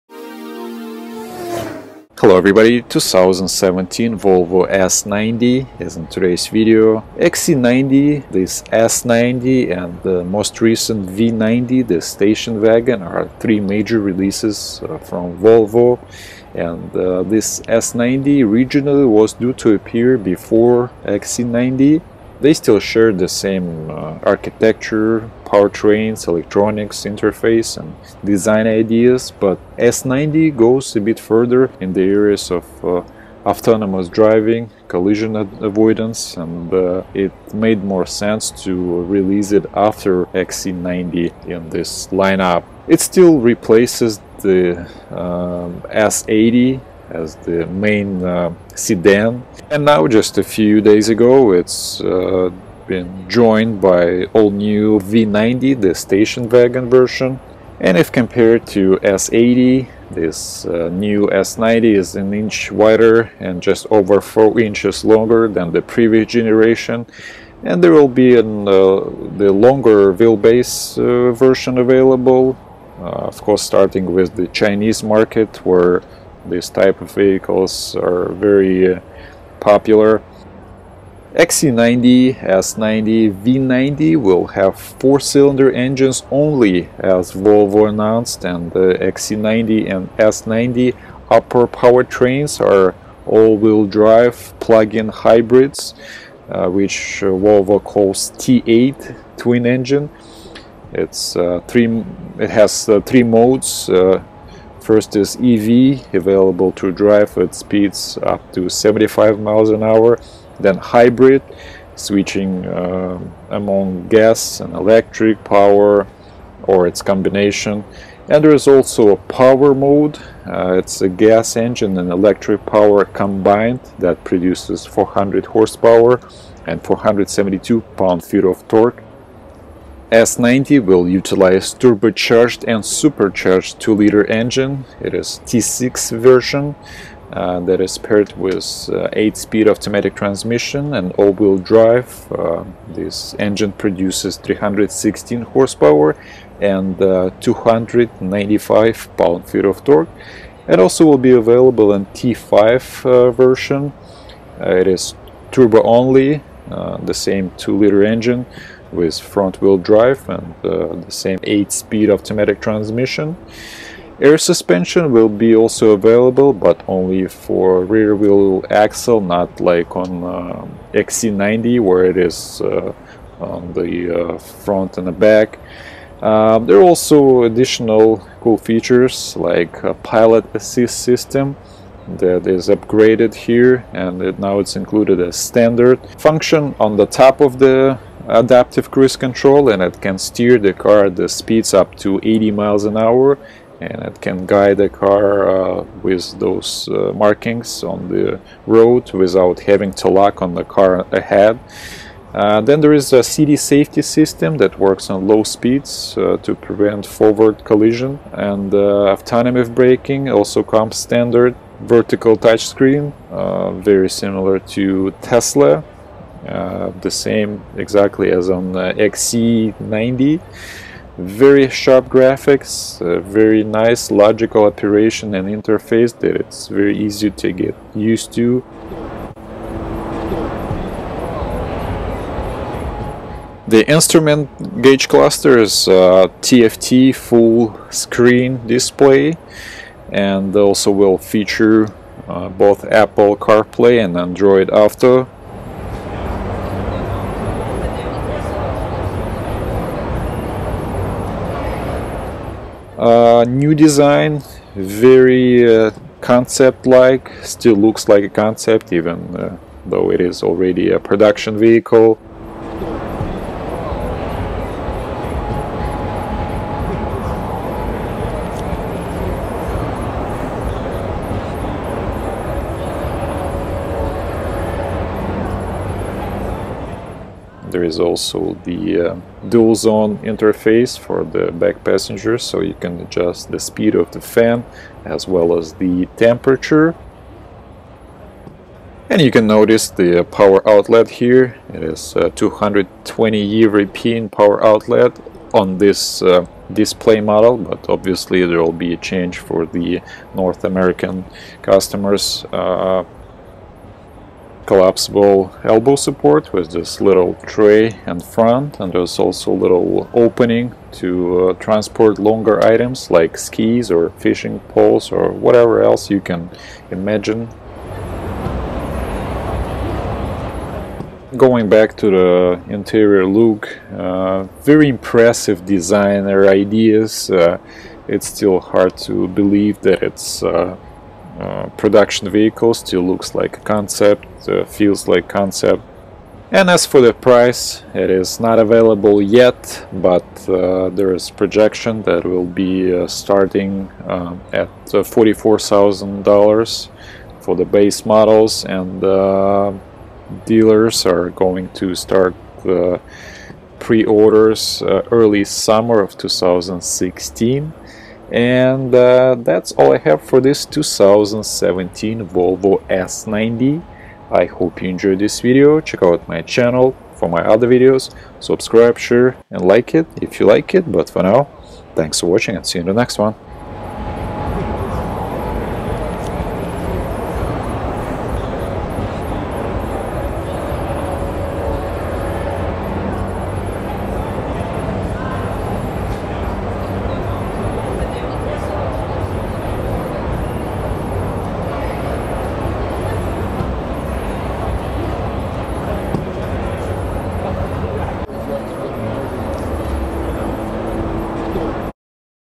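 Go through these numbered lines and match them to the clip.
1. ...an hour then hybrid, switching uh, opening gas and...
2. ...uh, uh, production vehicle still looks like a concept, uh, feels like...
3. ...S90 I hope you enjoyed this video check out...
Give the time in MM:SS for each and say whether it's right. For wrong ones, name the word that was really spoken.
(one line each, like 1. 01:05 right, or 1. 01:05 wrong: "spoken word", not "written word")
1. 01:49 wrong: "among", not "opening"
2. 05:30 right
3. 06:02 right.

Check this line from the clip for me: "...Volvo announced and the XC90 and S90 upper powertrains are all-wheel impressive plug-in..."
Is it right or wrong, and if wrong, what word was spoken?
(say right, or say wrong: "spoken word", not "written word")
wrong: "drive", not "impressive".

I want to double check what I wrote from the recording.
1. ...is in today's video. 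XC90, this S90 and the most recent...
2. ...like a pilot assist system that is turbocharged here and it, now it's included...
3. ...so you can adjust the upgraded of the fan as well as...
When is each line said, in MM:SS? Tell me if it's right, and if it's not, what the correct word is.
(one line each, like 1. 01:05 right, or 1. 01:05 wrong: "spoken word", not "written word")
1. 00:05 right
2. 02:59 wrong: "upgraded", not "turbocharged"
3. 04:42 wrong: "speed", not "upgraded".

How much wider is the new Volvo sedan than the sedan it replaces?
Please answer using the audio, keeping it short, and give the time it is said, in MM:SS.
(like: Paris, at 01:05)
1 inch, at 01:02.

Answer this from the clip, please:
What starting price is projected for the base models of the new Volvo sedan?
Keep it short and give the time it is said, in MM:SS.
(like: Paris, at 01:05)
$44,000, at 05:44.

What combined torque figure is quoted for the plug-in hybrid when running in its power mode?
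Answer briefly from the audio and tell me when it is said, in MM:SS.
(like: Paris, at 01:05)
472 pound-feet, at 02:06.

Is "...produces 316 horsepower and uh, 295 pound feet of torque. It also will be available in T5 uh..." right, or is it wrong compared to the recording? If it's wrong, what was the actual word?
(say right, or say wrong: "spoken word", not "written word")
right.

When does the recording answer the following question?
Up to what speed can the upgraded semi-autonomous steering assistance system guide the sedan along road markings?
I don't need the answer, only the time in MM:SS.
03:12.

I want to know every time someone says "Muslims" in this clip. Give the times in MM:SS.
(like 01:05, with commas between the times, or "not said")
not said.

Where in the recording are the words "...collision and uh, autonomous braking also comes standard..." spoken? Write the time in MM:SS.
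03:27.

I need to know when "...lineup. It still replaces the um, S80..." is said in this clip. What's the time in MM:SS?
00:42.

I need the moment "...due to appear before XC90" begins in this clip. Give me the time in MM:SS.
00:19.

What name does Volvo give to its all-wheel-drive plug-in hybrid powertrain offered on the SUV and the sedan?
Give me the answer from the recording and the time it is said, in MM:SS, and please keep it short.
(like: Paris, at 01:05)
T8 twin engine, at 01:38.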